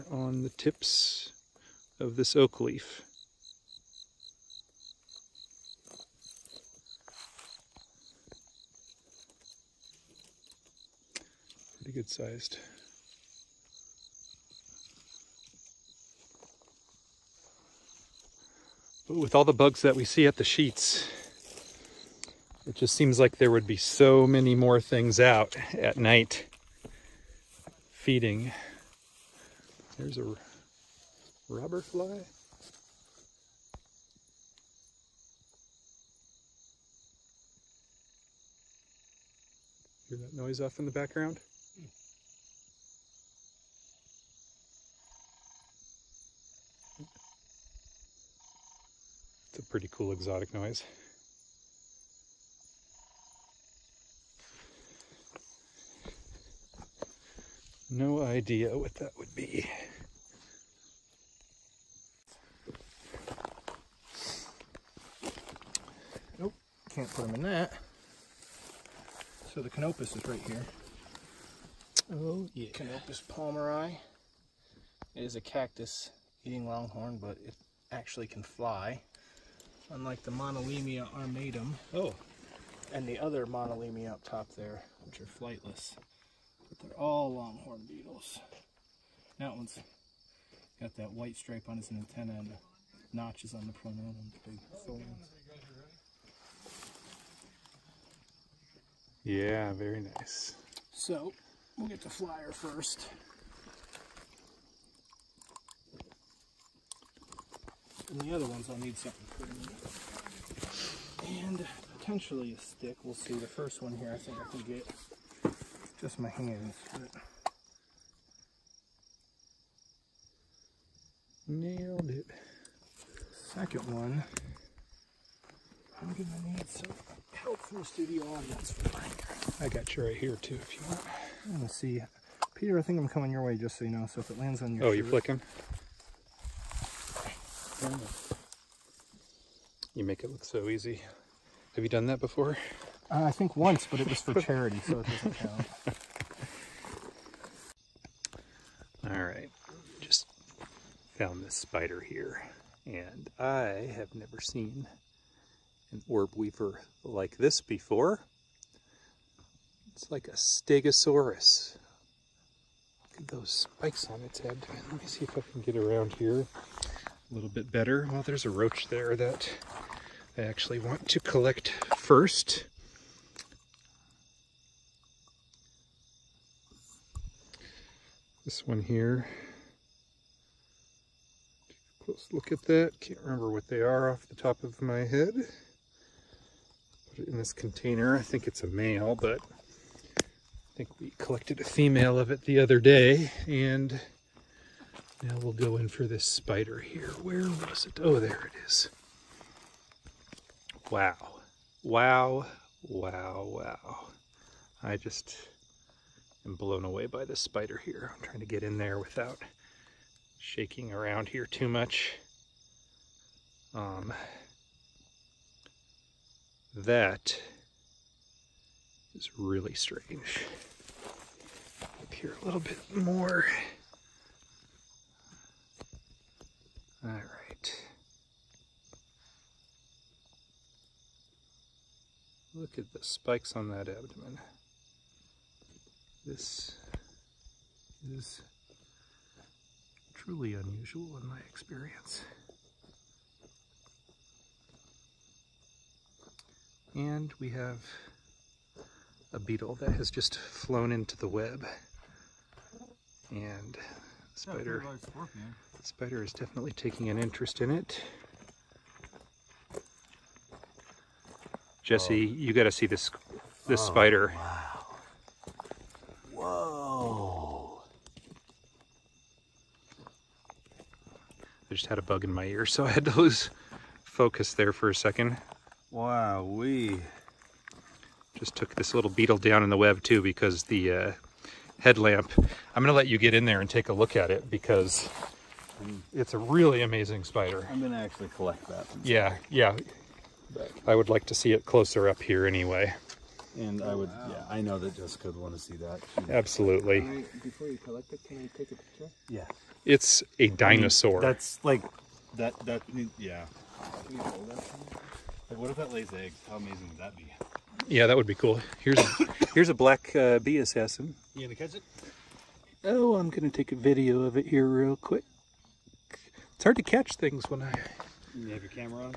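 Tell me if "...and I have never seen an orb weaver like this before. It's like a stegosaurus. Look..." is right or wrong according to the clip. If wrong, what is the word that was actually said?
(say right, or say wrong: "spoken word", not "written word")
right.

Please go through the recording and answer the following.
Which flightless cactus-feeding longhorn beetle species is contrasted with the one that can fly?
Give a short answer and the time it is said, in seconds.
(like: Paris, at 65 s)
Moneilema armatum, at 80 s.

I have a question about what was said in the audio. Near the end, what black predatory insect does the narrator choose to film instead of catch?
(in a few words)
bee assassin.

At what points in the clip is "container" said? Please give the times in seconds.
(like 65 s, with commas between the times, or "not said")
187 s.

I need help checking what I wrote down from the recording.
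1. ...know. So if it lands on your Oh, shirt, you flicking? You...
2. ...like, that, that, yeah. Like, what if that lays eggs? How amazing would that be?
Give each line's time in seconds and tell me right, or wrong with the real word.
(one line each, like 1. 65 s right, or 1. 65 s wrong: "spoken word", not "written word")
1. 133 s right
2. 301 s right.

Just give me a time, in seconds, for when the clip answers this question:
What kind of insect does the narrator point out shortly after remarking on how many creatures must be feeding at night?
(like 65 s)
30 s.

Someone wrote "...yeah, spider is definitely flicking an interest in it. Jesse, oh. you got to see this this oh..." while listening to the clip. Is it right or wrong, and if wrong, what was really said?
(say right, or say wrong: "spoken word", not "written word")
wrong: "taking", not "flicking".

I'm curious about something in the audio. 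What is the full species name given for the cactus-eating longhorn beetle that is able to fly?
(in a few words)
Coenopaeus palmeri.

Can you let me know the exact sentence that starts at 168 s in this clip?
Well, there's a roach there that I actually want to collect first.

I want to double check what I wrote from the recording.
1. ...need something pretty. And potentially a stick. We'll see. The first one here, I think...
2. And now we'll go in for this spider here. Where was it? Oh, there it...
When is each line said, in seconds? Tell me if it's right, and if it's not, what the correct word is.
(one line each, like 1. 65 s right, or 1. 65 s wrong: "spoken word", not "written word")
1. 108 s right
2. 193 s right.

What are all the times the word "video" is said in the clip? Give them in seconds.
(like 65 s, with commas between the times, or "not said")
313 s.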